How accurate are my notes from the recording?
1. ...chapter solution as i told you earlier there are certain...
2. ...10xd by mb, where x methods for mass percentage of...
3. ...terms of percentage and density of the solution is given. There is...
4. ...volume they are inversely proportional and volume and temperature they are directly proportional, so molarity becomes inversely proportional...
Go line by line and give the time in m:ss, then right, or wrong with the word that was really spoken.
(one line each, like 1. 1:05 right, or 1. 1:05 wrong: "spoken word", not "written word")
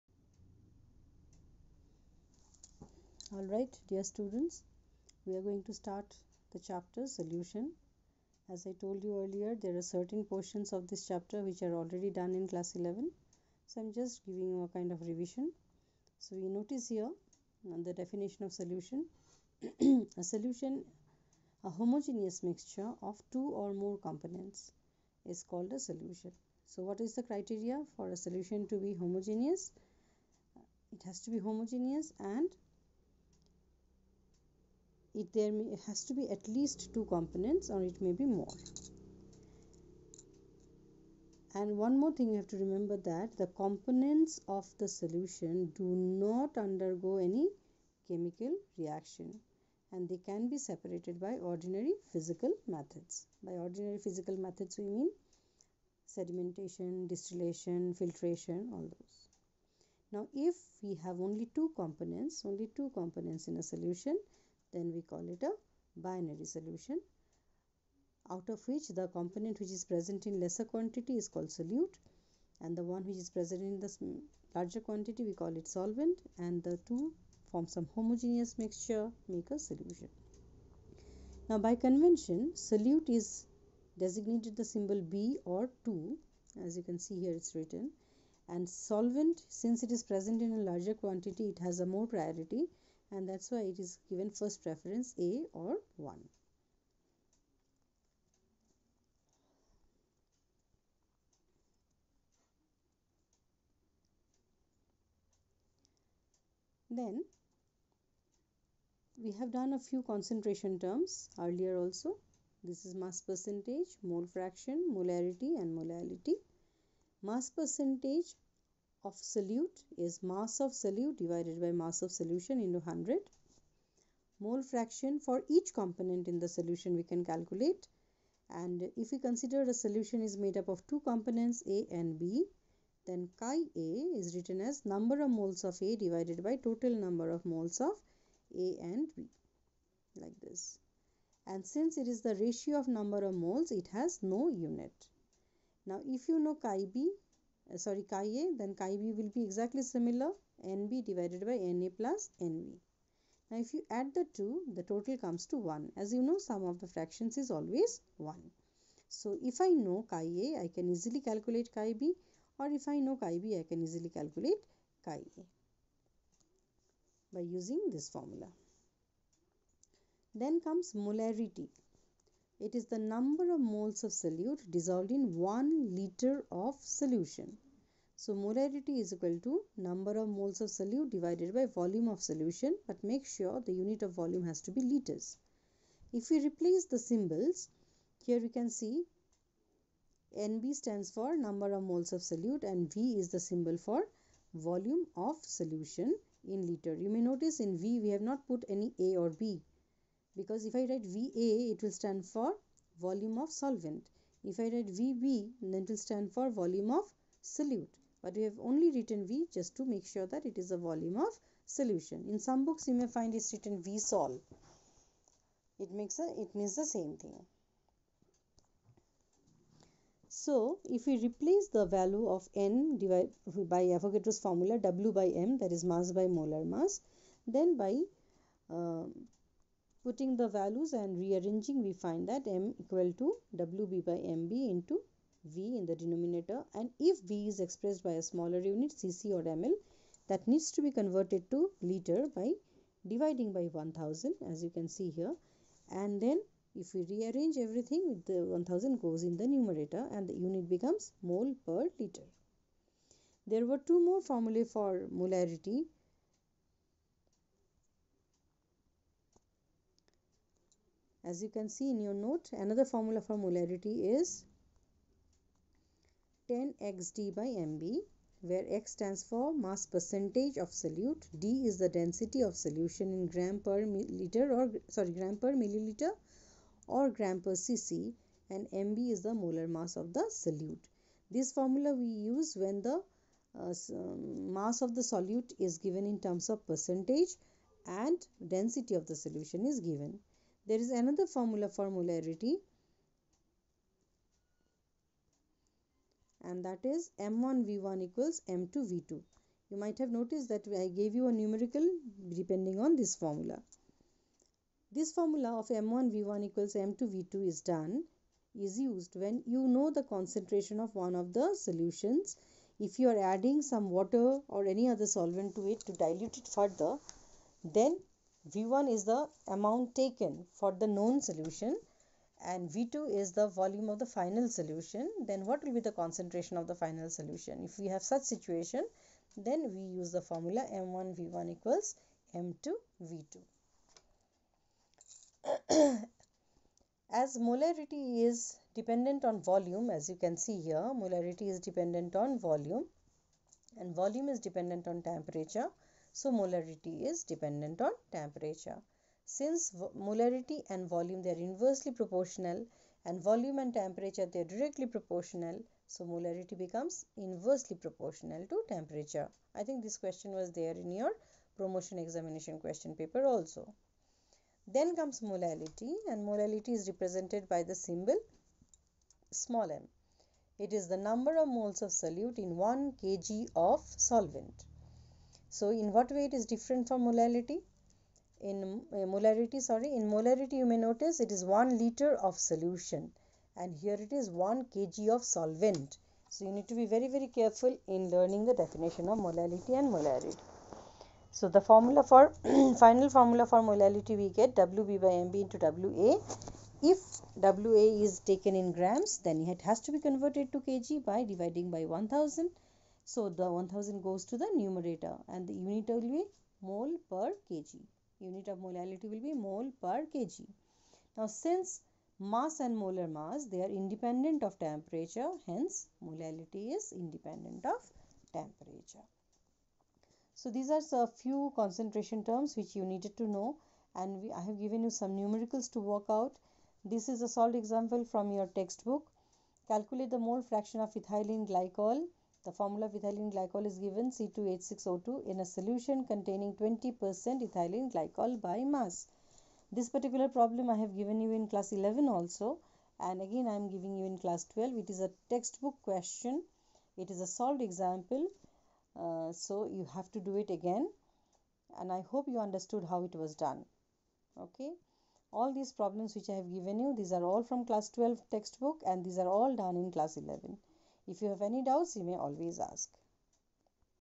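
1. 0:06 right
2. 4:26 wrong: "stands", not "methods"
3. 4:46 right
4. 5:50 right.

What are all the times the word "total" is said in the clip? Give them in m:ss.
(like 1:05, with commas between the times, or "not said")
2:16, 2:34.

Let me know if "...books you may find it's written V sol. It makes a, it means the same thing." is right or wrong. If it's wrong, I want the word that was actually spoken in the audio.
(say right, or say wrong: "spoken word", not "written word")
right.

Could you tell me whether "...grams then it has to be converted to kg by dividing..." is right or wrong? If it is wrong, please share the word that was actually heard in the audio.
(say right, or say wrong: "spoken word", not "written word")
right.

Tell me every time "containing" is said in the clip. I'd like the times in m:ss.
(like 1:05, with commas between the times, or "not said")
7:16.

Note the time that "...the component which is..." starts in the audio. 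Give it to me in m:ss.
1:08.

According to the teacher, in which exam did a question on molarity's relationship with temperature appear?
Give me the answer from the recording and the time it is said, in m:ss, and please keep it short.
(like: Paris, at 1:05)
Promotion examination, at 6:01.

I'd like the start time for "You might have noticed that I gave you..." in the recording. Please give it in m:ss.
4:59.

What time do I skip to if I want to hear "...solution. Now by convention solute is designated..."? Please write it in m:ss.
1:19.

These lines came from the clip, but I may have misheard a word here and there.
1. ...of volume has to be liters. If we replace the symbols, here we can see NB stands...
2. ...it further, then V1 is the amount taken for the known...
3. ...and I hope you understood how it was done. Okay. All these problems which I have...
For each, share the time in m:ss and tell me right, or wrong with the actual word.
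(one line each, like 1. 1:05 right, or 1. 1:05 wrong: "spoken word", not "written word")
1. 3:04 right
2. 5:16 right
3. 7:31 right.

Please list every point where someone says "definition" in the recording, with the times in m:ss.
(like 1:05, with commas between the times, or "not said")
0:17, 6:28.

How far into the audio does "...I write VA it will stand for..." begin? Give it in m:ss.
3:20.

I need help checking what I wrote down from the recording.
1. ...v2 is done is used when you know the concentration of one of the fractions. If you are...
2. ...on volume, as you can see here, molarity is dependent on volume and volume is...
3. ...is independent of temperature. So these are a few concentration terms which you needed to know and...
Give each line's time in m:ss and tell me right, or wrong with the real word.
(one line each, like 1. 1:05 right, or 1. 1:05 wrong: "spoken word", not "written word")
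1. 5:07 wrong: "solutions", not "fractions"
2. 5:39 right
3. 6:56 right.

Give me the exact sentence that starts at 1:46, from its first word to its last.
Then we have done a few concentration terms earlier also.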